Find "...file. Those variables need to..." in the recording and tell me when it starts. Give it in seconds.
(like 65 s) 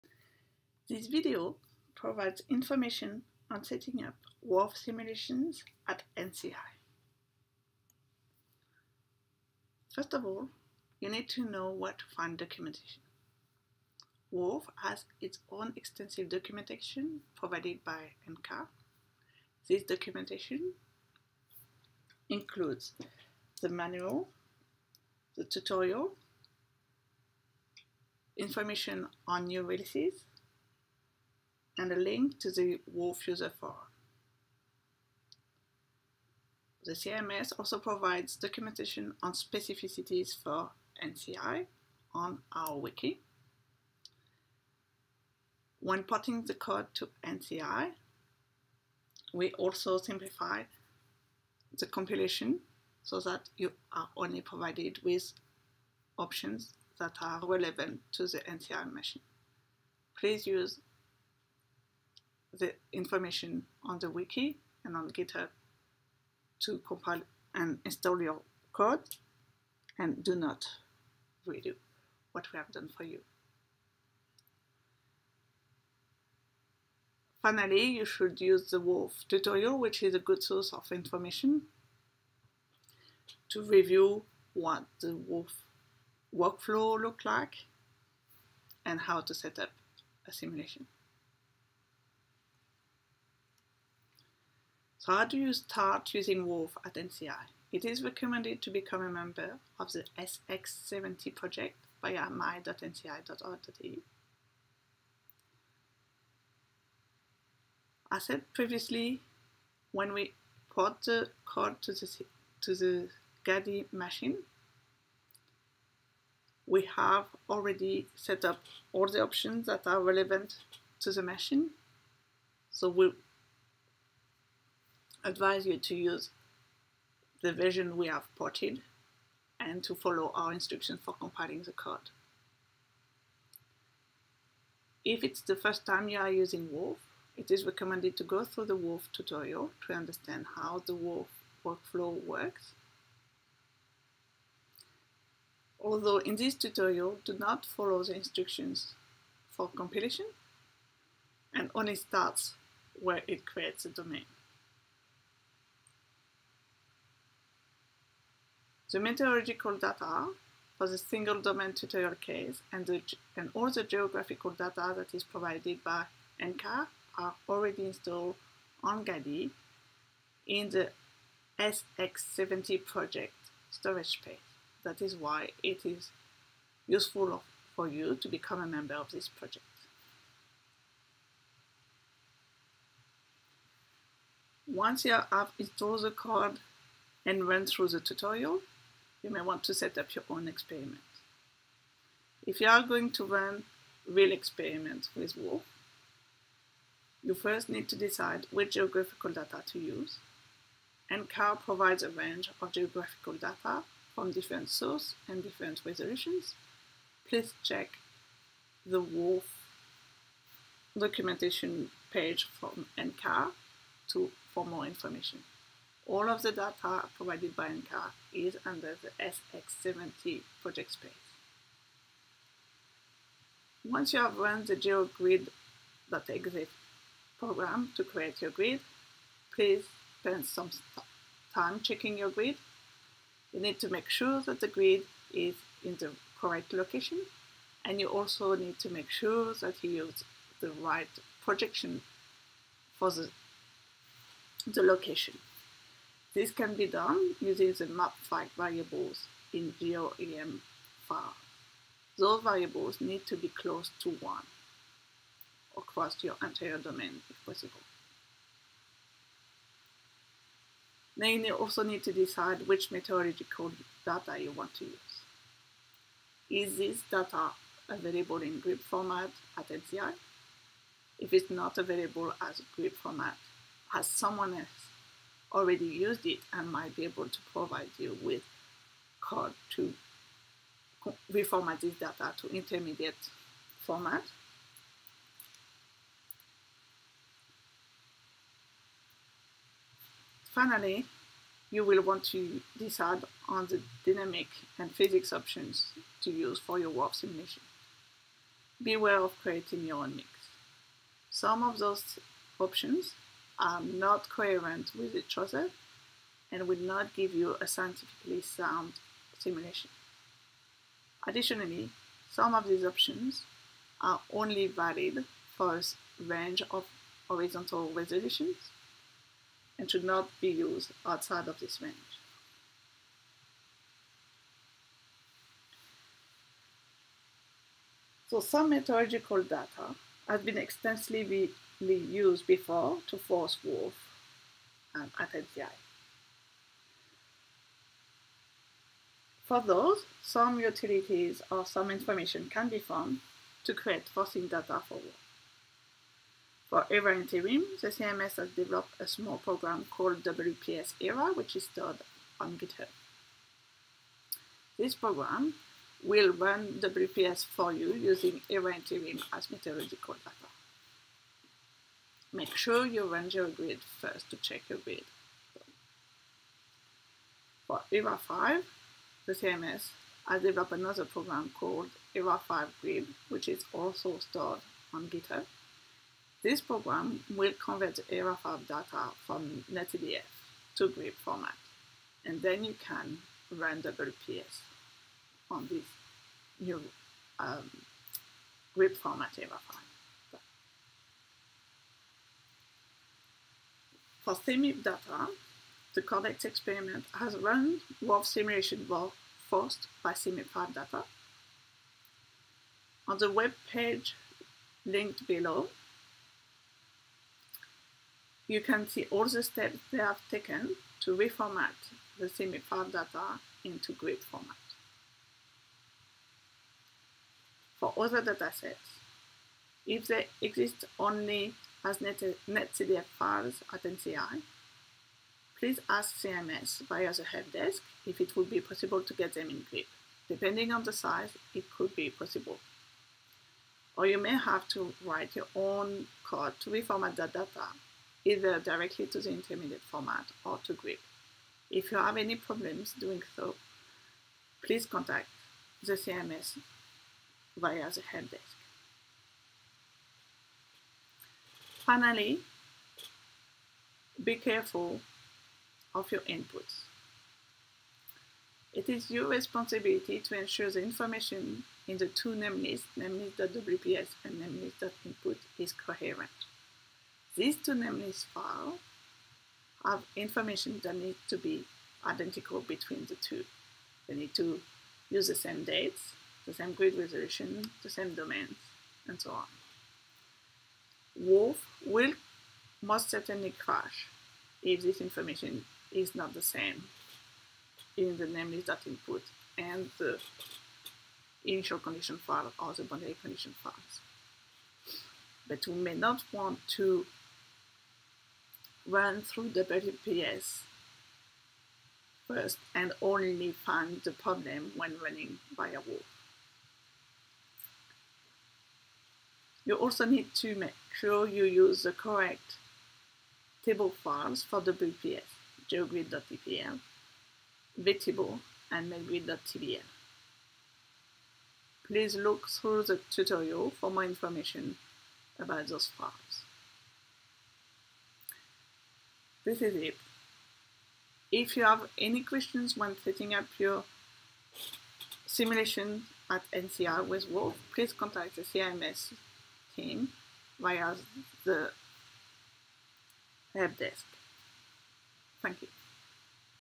251 s.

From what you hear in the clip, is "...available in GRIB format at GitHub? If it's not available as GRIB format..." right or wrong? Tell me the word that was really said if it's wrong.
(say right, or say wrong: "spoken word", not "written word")
wrong: "NCI", not "GitHub".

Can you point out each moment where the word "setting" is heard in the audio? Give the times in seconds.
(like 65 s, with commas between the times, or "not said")
3 s, 533 s.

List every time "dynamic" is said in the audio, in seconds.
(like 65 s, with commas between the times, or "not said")
294 s.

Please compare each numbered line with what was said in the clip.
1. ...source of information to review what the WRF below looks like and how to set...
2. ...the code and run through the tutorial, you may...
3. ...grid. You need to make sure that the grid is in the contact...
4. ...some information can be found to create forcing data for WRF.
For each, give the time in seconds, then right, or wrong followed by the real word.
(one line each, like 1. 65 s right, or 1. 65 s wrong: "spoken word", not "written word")
1. 80 s wrong: "workflow", not "below"
2. 186 s right
3. 232 s wrong: "correct", not "contact"
4. 341 s right.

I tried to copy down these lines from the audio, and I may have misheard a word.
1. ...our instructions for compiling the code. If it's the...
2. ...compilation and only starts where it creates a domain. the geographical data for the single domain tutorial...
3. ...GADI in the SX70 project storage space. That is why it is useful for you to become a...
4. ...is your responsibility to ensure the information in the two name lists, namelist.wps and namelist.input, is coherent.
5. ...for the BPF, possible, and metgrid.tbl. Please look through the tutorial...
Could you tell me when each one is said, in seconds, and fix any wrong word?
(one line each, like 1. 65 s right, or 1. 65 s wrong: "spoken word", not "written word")
1. 130 s right
2. 149 s wrong: "meteorological", not "geographical"
3. 169 s right
4. 458 s right
5. 514 s wrong: "vtable", not "possible".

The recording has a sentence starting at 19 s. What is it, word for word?
This documentation includes the manual, the tutorial, information on new releases, and a link to the WRF user Forum.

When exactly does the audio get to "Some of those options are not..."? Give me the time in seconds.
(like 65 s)
301 s.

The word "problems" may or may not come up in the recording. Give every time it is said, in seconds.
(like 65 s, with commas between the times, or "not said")
442 s, 504 s.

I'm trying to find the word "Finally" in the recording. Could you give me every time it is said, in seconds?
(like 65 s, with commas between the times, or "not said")
77 s, 290 s, 451 s.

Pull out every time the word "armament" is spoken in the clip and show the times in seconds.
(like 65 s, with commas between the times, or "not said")
not said.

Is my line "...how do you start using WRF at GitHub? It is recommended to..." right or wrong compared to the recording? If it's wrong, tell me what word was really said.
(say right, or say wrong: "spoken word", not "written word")
wrong: "NCI", not "GitHub".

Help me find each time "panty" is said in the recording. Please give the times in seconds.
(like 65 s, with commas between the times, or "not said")
not said.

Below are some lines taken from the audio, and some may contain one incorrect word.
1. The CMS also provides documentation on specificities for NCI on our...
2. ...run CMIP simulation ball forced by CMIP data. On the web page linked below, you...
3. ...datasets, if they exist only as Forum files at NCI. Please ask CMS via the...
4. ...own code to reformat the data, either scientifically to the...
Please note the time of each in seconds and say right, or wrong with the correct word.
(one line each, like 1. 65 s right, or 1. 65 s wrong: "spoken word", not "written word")
1. 36 s right
2. 397 s wrong: "WRF", not "CMIP"
3. 418 s wrong: "NetCDF", not "Forum"
4. 435 s wrong: "directly", not "scientifically".